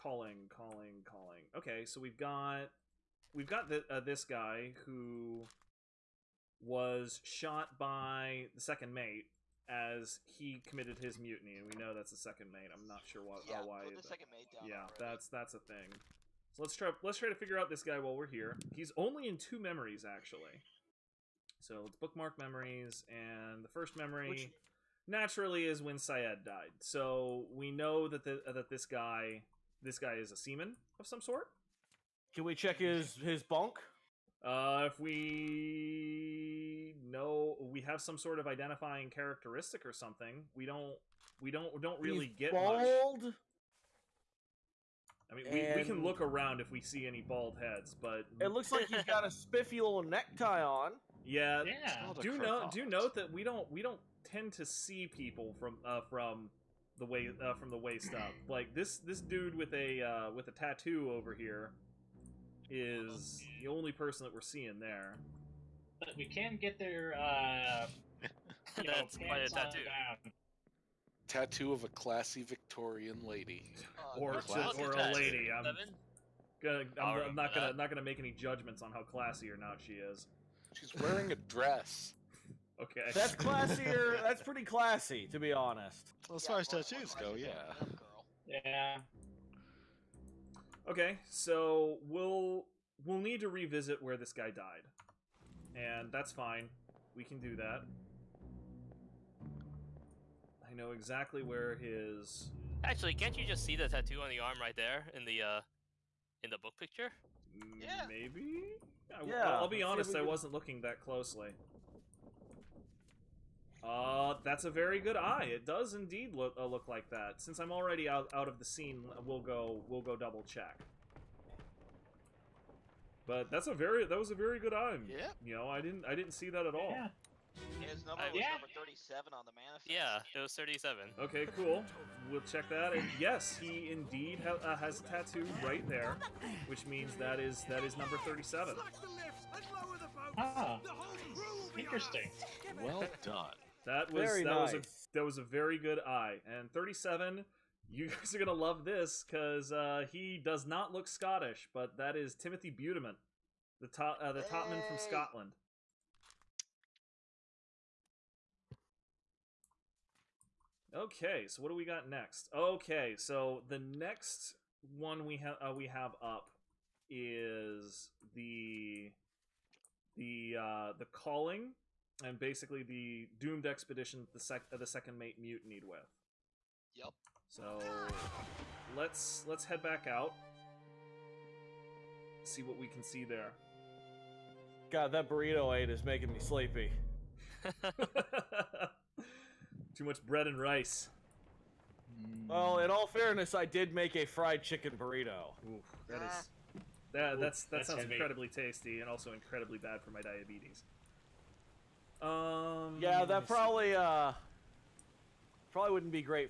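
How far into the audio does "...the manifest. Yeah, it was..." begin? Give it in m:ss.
2:09.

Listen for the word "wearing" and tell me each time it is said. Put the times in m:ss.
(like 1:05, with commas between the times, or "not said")
1:21.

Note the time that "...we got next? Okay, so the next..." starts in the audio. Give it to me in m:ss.
2:41.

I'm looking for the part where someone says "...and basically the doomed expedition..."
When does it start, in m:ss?
2:52.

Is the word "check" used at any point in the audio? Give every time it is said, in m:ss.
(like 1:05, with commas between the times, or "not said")
0:32, 2:00, 2:12.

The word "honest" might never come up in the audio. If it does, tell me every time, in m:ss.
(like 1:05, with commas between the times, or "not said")
1:25, 1:49.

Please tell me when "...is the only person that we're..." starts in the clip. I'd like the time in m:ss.
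1:02.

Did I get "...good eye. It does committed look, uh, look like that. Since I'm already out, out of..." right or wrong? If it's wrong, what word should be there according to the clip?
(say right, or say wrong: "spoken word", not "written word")
wrong: "indeed", not "committed".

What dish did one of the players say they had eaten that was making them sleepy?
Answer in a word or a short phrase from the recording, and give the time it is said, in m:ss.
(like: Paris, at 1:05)
Fried chicken burrito, at 3:14.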